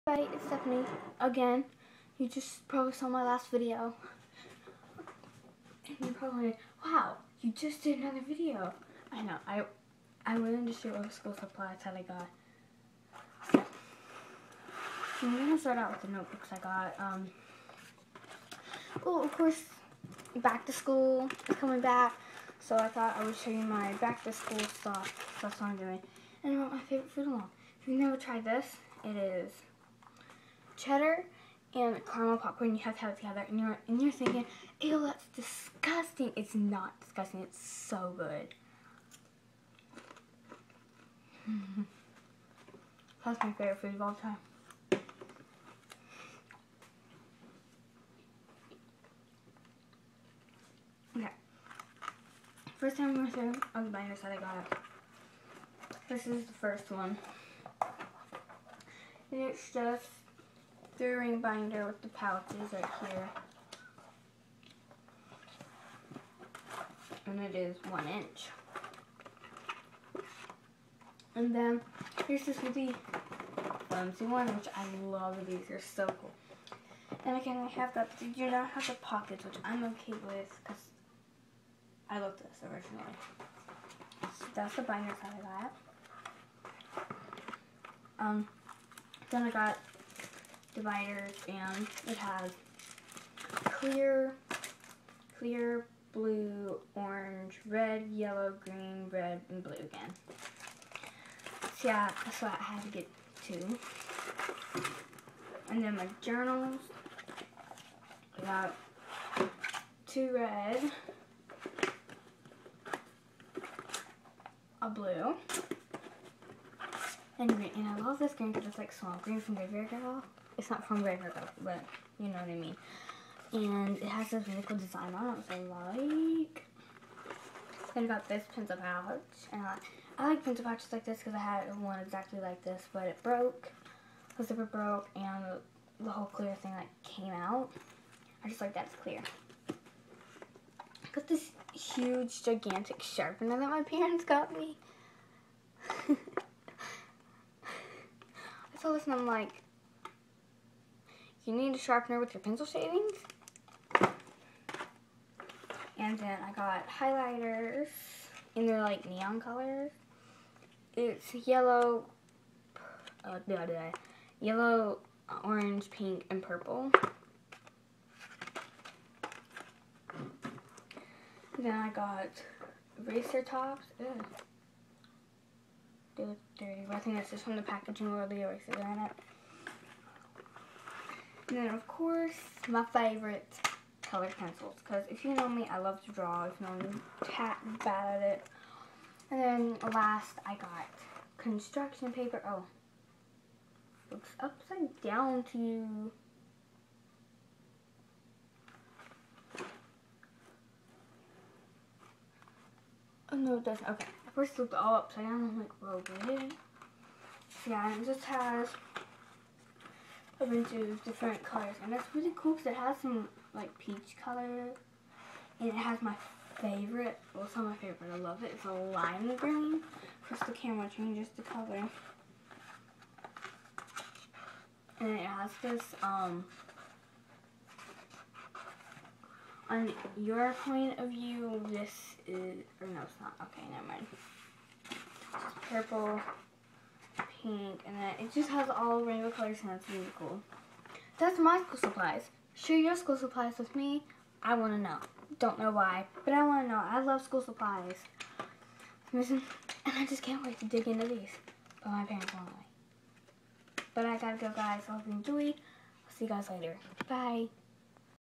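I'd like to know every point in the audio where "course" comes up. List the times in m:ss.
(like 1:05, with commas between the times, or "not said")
0:19, 3:01.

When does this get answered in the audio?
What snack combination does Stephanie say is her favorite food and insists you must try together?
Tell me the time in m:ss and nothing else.
0:30.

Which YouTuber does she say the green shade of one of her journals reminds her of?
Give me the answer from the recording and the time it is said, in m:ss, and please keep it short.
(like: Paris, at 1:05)
Graveyard Girl, at 1:59.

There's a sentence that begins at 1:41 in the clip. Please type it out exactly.
So yeah, that's what I had to get two.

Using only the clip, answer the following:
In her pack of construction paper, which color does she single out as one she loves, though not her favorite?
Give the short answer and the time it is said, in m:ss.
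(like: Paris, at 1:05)
Lime green, at 3:38.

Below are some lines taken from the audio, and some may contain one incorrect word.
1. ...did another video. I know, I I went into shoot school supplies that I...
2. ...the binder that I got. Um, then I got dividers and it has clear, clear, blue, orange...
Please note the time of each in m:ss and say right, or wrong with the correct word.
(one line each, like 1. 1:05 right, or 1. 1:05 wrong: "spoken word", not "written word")
1. 0:07 right
2. 1:24 right.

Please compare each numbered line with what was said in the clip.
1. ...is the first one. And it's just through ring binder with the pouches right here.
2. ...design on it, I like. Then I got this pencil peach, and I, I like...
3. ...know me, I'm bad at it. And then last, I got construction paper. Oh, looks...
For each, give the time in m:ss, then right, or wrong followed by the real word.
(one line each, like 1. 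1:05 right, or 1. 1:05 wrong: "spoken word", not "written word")
1. 0:56 right
2. 2:04 wrong: "pouch", not "peach"
3. 3:06 right.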